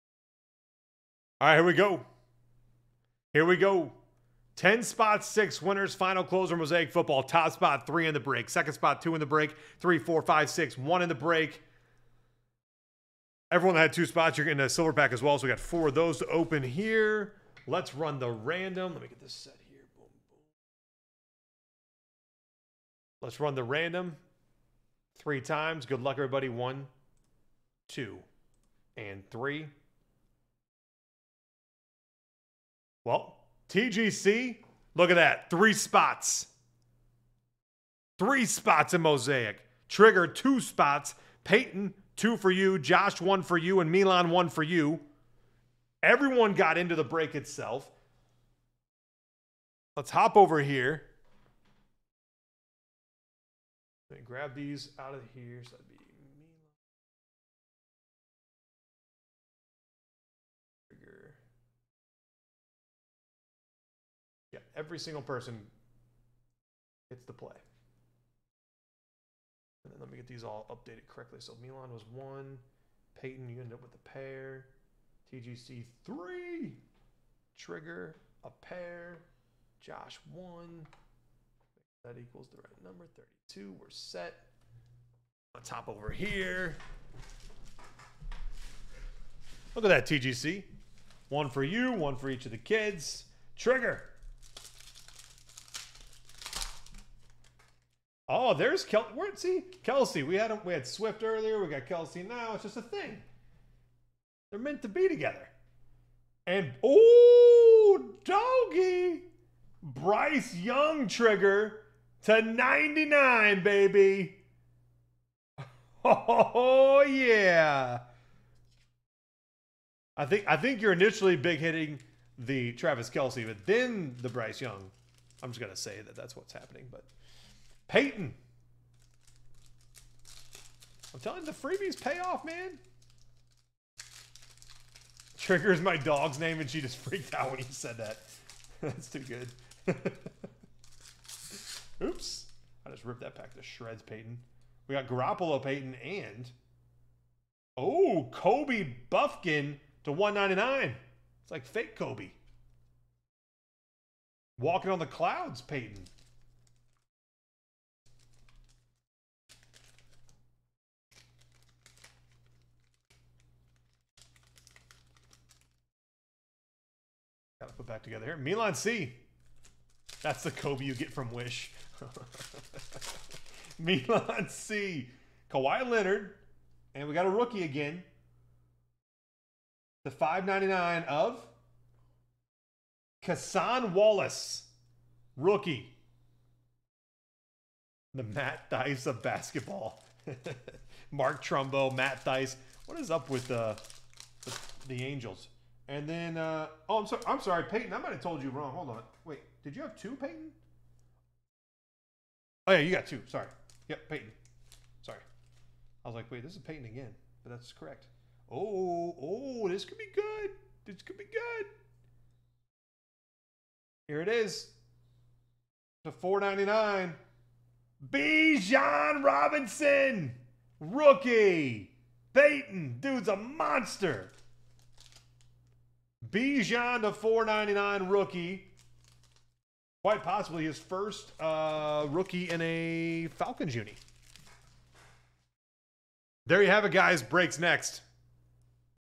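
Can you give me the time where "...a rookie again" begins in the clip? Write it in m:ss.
2:57.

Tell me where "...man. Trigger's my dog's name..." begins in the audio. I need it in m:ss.
2:12.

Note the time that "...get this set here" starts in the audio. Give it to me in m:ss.
0:19.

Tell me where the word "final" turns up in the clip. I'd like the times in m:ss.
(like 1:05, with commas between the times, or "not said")
0:05.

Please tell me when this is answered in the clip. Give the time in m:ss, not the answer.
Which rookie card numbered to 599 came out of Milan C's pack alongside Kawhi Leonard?
3:03.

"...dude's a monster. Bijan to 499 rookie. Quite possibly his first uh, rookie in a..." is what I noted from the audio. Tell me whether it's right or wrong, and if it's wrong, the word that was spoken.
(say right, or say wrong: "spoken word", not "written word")
right.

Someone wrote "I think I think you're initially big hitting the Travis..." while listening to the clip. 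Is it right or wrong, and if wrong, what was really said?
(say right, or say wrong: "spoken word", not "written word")
right.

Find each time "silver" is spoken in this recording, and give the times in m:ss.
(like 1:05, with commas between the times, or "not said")
0:14.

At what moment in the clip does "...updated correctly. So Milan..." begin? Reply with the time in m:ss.
1:10.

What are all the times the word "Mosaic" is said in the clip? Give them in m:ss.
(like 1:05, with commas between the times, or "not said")
0:06, 0:39.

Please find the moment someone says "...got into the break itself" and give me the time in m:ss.
0:46.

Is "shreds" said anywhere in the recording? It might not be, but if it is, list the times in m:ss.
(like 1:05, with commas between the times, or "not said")
2:23.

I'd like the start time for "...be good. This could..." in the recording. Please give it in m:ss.
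3:29.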